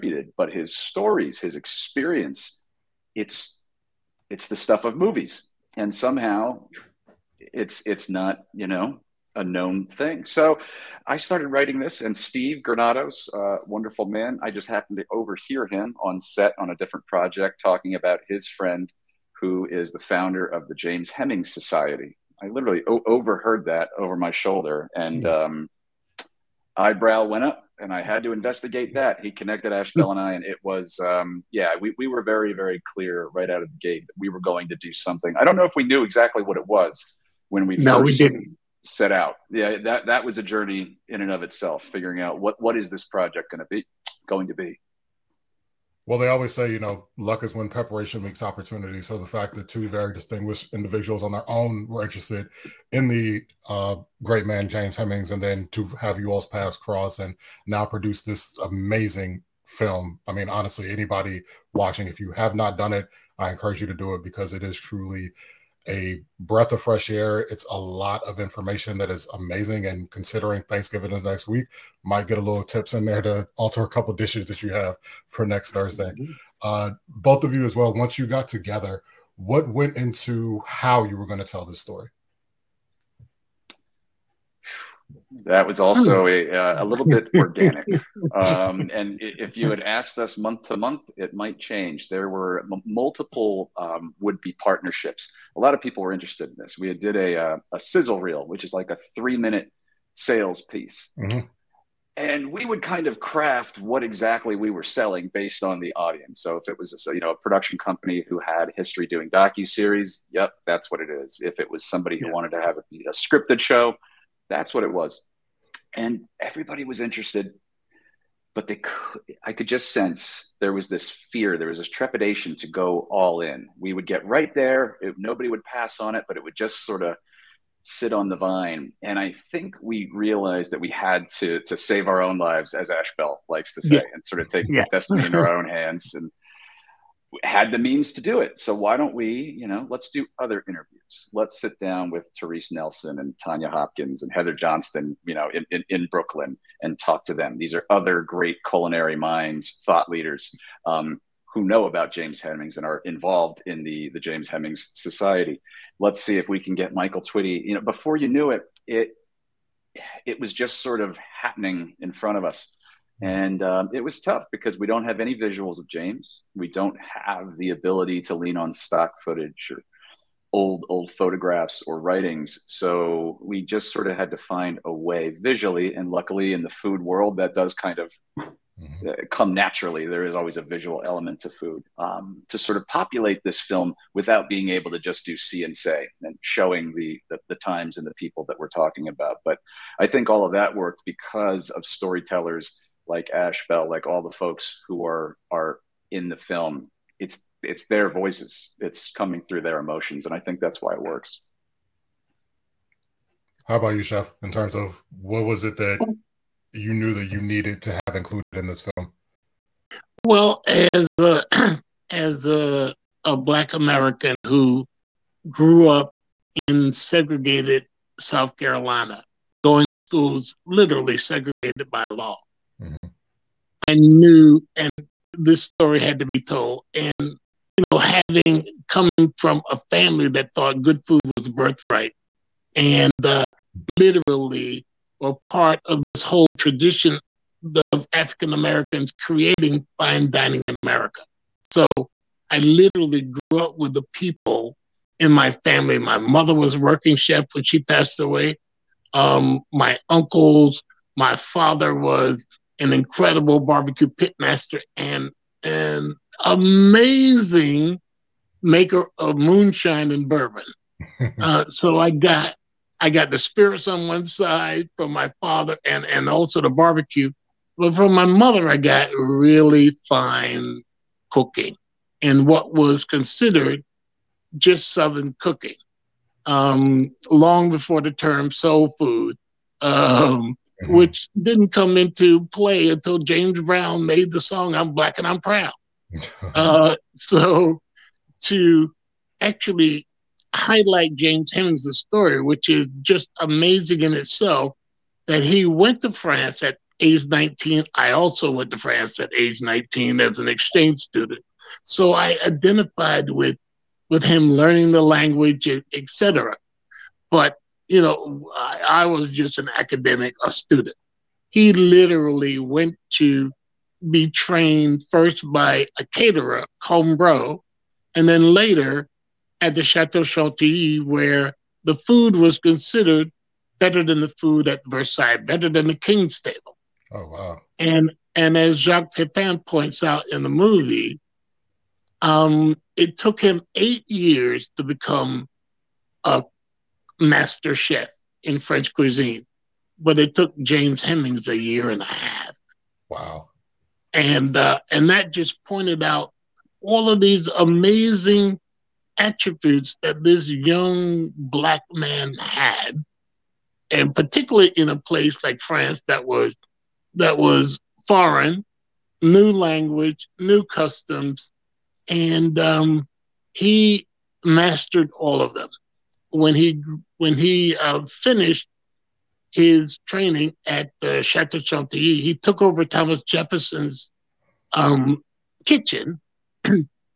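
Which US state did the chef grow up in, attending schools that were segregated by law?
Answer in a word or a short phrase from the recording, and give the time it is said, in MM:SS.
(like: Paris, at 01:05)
South Carolina, at 03:38.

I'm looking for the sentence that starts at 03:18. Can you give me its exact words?
It's coming through their emotions, and I think that's why it works.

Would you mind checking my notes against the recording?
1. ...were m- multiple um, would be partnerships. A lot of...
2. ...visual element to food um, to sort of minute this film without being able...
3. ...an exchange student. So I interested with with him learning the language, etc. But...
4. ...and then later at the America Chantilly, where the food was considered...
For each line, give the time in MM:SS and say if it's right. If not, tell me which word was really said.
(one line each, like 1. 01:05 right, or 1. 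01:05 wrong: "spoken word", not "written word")
1. 01:32 right
2. 03:00 wrong: "populate", not "minute"
3. 05:00 wrong: "identified", not "interested"
4. 05:18 wrong: "Chateau", not "America".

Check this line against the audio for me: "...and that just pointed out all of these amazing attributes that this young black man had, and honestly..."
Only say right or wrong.
wrong.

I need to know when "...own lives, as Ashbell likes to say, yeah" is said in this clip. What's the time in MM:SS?
02:12.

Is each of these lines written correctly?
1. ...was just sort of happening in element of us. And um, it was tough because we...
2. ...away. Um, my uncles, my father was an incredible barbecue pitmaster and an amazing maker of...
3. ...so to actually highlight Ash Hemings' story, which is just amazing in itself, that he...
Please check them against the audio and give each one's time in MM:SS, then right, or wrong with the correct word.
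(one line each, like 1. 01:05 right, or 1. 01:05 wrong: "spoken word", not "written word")
1. 02:40 wrong: "front", not "element"
2. 04:08 right
3. 04:47 wrong: "James", not "Ash".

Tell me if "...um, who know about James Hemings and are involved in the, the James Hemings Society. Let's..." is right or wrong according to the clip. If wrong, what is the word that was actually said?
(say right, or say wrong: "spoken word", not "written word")
right.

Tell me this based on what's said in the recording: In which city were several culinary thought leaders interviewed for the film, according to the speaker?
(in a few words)
Brooklyn.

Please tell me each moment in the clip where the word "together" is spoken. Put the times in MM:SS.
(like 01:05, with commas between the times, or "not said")
01:18.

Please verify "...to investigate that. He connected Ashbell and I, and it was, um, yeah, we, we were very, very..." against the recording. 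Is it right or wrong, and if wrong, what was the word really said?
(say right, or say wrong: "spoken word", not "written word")
right.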